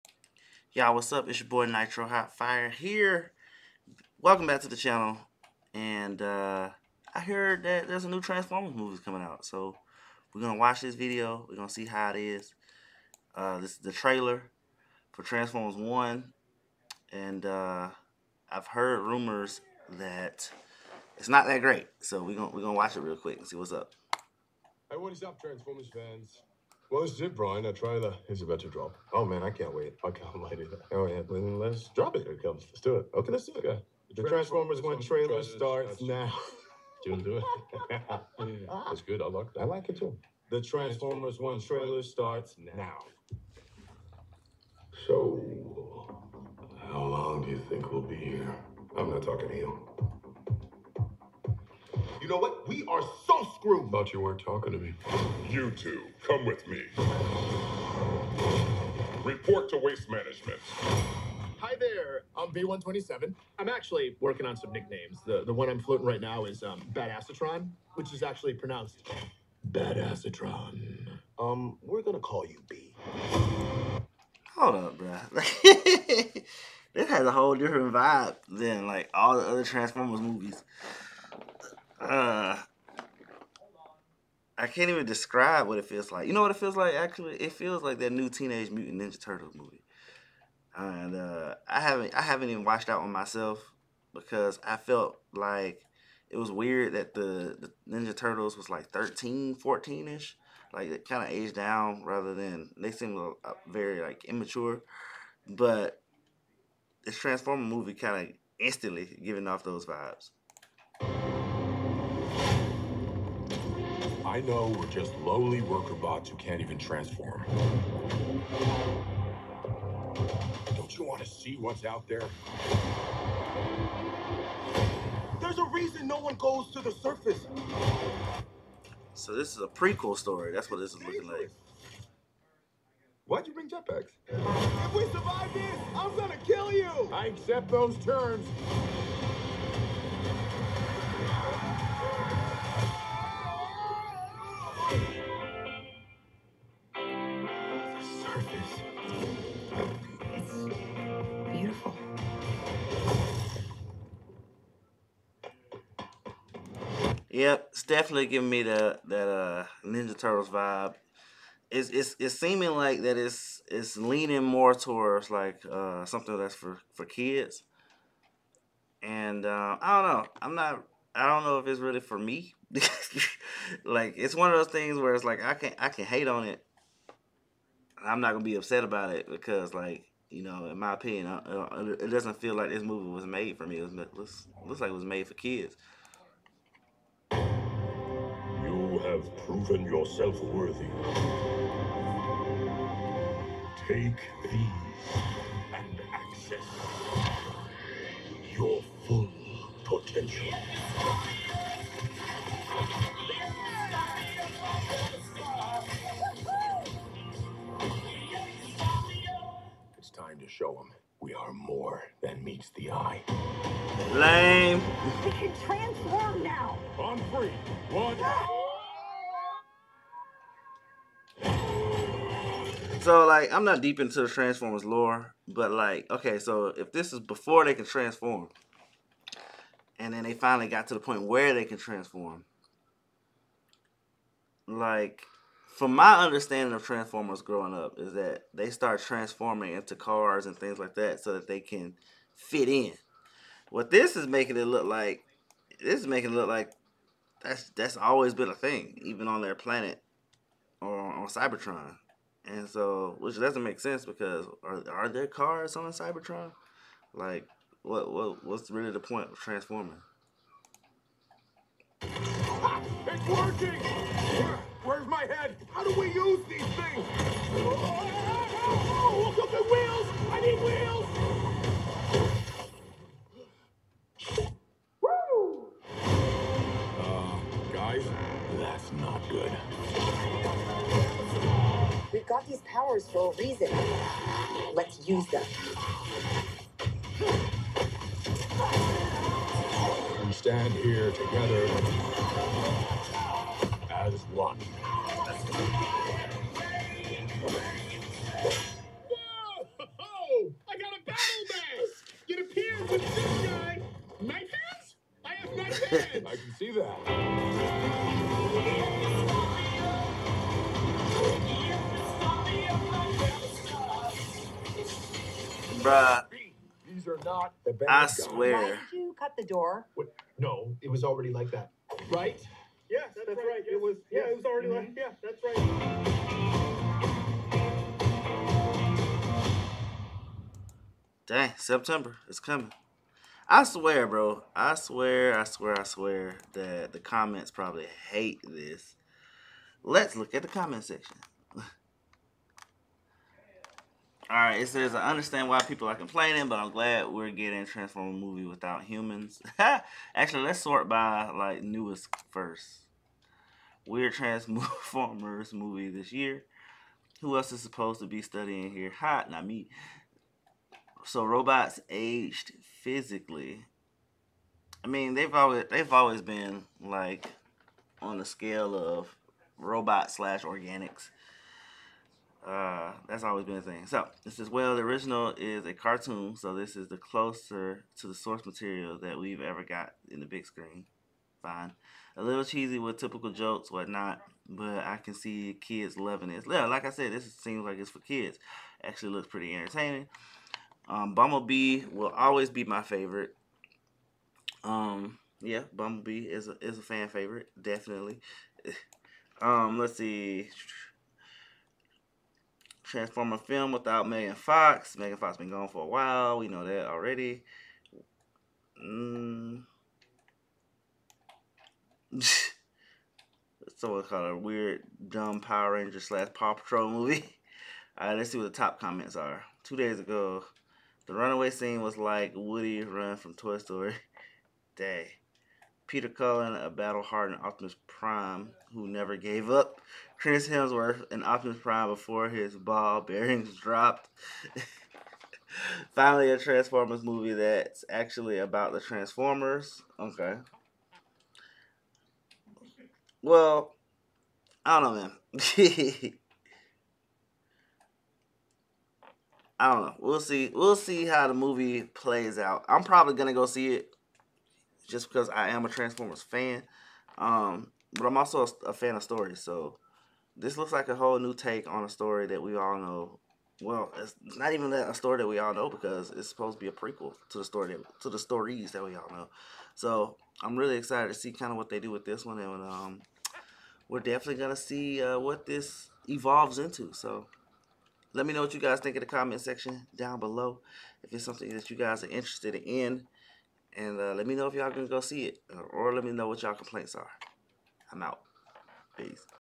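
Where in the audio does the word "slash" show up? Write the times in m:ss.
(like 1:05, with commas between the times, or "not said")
6:10, 6:56.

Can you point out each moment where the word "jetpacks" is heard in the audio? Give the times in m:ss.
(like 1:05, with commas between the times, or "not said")
2:13.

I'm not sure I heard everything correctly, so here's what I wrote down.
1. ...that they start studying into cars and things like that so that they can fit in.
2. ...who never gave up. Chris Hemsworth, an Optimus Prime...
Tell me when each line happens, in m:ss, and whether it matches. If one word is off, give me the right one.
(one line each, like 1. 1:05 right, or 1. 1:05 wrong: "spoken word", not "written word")
1. 3:58 wrong: "transforming", not "studying"
2. 7:08 right.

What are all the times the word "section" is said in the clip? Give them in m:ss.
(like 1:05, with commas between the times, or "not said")
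5:40, 7:59.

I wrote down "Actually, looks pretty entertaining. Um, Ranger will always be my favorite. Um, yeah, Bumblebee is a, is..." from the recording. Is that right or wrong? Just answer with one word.
wrong.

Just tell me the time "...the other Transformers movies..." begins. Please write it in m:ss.
1:19.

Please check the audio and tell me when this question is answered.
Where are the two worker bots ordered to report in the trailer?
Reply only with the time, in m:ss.
0:59.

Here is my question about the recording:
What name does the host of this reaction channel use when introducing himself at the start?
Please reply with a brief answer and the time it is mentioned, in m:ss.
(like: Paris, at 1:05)
Nitro Hot Fire, at 0:01.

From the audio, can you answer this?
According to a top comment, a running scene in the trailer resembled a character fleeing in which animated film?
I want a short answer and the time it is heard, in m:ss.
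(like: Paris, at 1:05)
Toy Story, at 7:03.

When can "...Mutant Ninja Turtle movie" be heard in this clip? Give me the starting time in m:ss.
1:28.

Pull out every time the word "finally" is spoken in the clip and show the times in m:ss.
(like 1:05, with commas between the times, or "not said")
3:50, 7:15.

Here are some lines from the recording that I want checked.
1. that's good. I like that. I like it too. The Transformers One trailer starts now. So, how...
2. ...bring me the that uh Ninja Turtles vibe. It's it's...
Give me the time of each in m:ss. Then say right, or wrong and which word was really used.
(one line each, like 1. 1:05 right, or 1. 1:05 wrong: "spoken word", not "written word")
1. 0:38 right
2. 2:38 wrong: "giving", not "bring".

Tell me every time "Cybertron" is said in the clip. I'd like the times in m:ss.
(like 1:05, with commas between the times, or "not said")
4:11, 4:15.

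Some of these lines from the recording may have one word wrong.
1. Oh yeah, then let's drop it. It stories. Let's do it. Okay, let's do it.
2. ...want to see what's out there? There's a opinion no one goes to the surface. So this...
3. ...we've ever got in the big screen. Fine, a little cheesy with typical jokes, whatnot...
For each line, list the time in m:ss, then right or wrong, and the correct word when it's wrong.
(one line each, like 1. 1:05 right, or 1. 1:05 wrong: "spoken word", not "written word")
1. 0:30 wrong: "comes", not "stories"
2. 2:01 wrong: "reason", not "opinion"
3. 6:19 right.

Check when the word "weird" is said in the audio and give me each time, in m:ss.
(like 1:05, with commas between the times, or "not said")
1:36, 5:53, 6:54.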